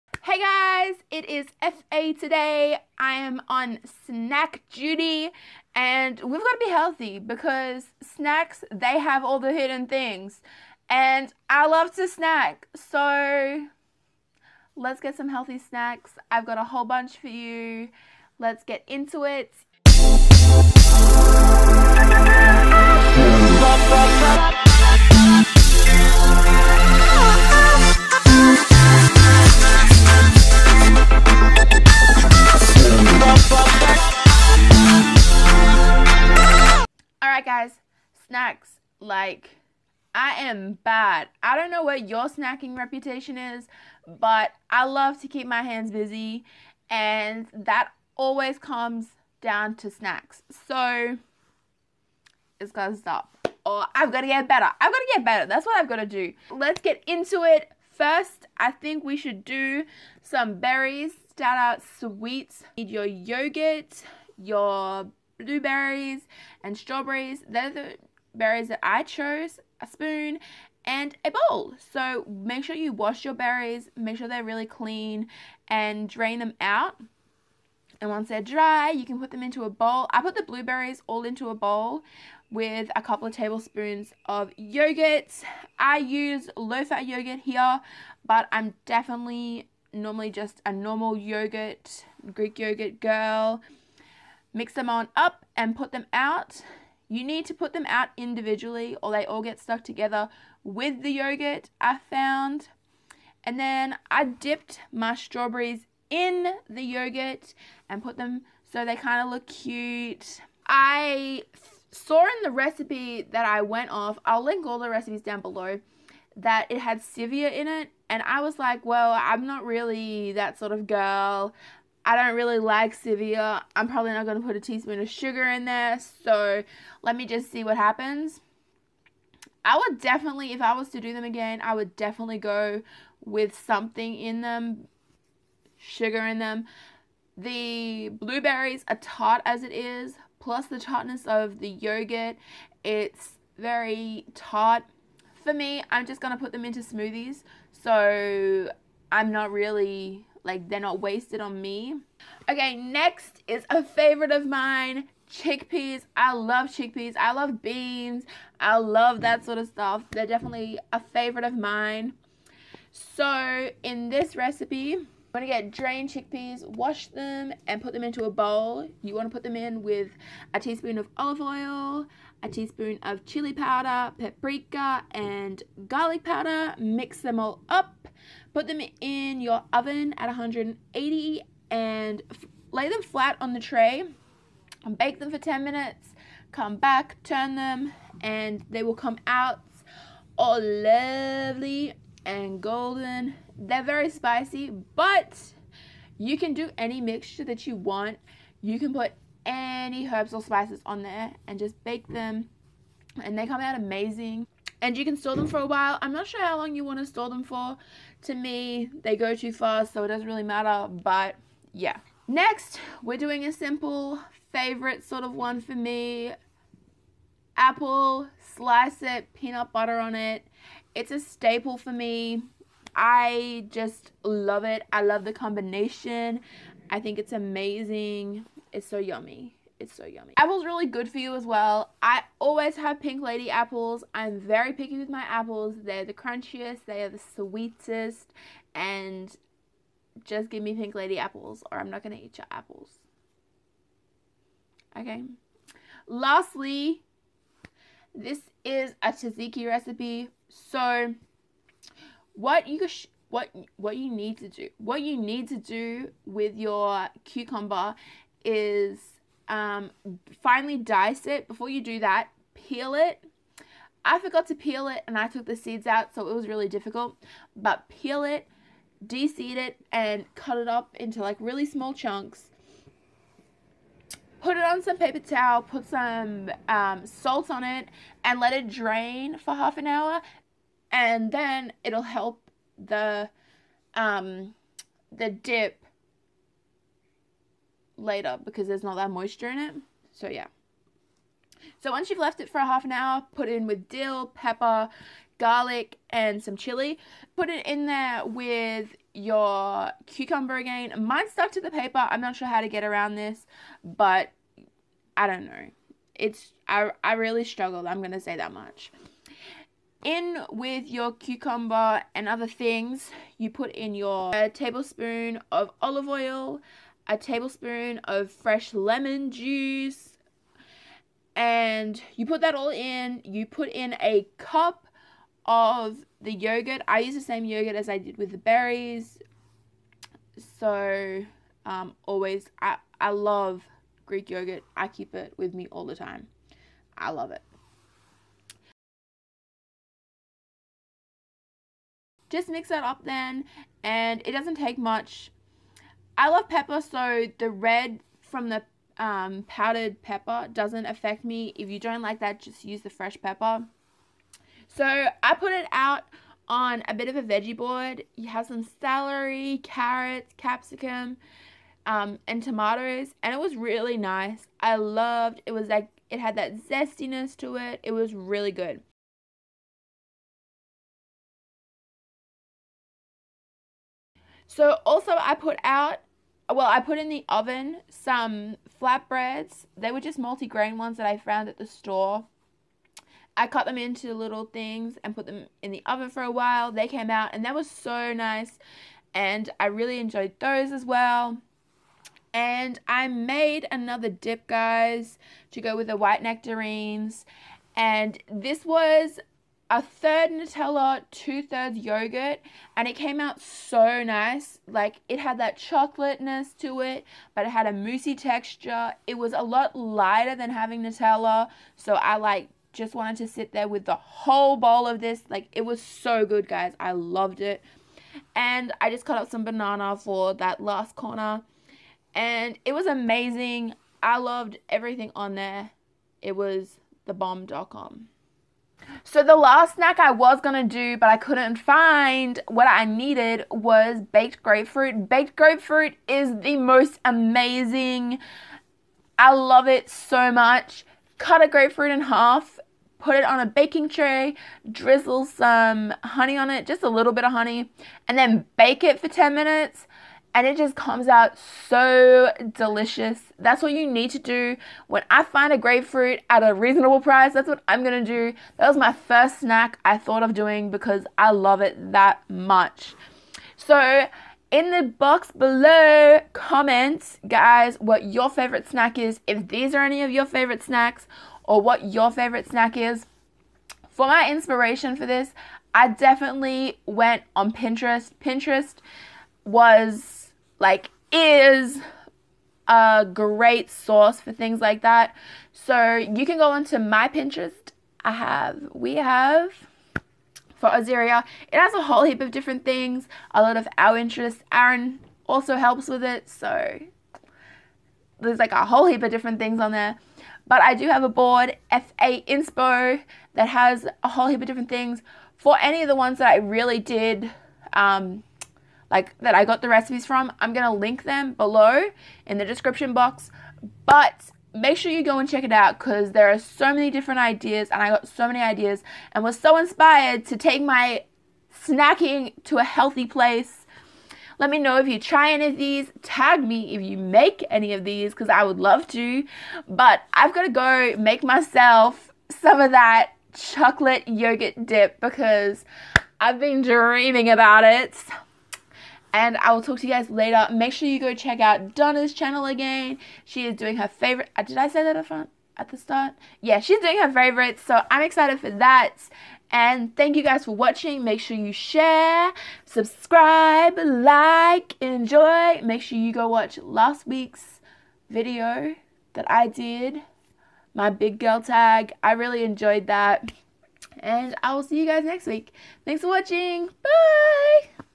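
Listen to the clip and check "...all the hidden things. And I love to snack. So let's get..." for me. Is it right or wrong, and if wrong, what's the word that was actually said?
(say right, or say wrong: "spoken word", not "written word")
right.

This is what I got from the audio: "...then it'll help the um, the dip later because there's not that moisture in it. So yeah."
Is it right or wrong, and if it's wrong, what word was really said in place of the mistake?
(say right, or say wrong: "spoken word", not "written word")
right.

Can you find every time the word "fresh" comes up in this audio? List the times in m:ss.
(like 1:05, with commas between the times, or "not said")
5:18, 5:52.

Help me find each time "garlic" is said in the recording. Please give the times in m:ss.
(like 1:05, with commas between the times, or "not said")
2:55, 4:55.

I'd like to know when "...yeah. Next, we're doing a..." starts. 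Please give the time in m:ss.
3:31.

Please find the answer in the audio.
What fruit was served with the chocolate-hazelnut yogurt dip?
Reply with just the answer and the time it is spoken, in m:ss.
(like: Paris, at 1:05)
white nectarines, at 6:35.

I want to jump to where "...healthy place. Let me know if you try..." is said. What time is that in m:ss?
8:42.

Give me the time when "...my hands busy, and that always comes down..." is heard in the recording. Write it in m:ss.
0:45.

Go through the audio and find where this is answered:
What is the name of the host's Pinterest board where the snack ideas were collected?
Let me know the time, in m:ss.
8:21.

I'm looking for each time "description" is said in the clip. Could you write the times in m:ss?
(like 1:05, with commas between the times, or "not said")
8:32.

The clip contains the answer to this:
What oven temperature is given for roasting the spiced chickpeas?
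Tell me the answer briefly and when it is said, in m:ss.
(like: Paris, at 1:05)
180, at 3:00.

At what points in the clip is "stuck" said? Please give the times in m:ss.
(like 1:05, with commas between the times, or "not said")
1:39, 5:01.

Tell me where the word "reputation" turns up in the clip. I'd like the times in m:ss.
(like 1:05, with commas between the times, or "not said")
0:42.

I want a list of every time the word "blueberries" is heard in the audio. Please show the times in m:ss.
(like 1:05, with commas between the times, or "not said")
1:05, 1:20, 2:18.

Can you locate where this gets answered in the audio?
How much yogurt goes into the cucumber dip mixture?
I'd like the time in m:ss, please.
5:24.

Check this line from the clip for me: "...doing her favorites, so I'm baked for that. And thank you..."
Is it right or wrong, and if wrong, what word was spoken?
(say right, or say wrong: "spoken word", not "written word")
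wrong: "excited", not "baked".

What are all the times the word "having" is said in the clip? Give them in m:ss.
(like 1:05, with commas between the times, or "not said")
6:50.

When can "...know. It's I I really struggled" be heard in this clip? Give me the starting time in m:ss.
5:05.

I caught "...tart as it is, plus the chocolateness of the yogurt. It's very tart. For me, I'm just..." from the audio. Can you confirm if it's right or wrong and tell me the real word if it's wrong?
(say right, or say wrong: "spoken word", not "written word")
wrong: "tartness", not "chocolateness".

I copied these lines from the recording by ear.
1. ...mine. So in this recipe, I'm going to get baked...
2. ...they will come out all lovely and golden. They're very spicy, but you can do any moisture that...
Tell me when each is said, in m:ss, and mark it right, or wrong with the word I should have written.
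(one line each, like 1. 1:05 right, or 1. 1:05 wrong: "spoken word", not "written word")
1. 2:41 wrong: "drained", not "baked"
2. 3:08 wrong: "mixture", not "moisture".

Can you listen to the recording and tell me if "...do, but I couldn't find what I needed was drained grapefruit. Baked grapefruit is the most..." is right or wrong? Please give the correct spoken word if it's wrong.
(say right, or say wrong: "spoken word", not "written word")
wrong: "baked", not "drained".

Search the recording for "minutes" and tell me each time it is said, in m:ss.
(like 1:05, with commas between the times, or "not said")
3:05, 7:29.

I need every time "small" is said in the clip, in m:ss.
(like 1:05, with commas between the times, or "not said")
4:31.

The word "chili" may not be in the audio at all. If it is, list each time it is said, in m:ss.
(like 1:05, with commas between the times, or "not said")
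2:53, 4:56.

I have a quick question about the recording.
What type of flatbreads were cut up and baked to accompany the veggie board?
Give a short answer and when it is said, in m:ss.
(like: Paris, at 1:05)
multi-grain, at 6:20.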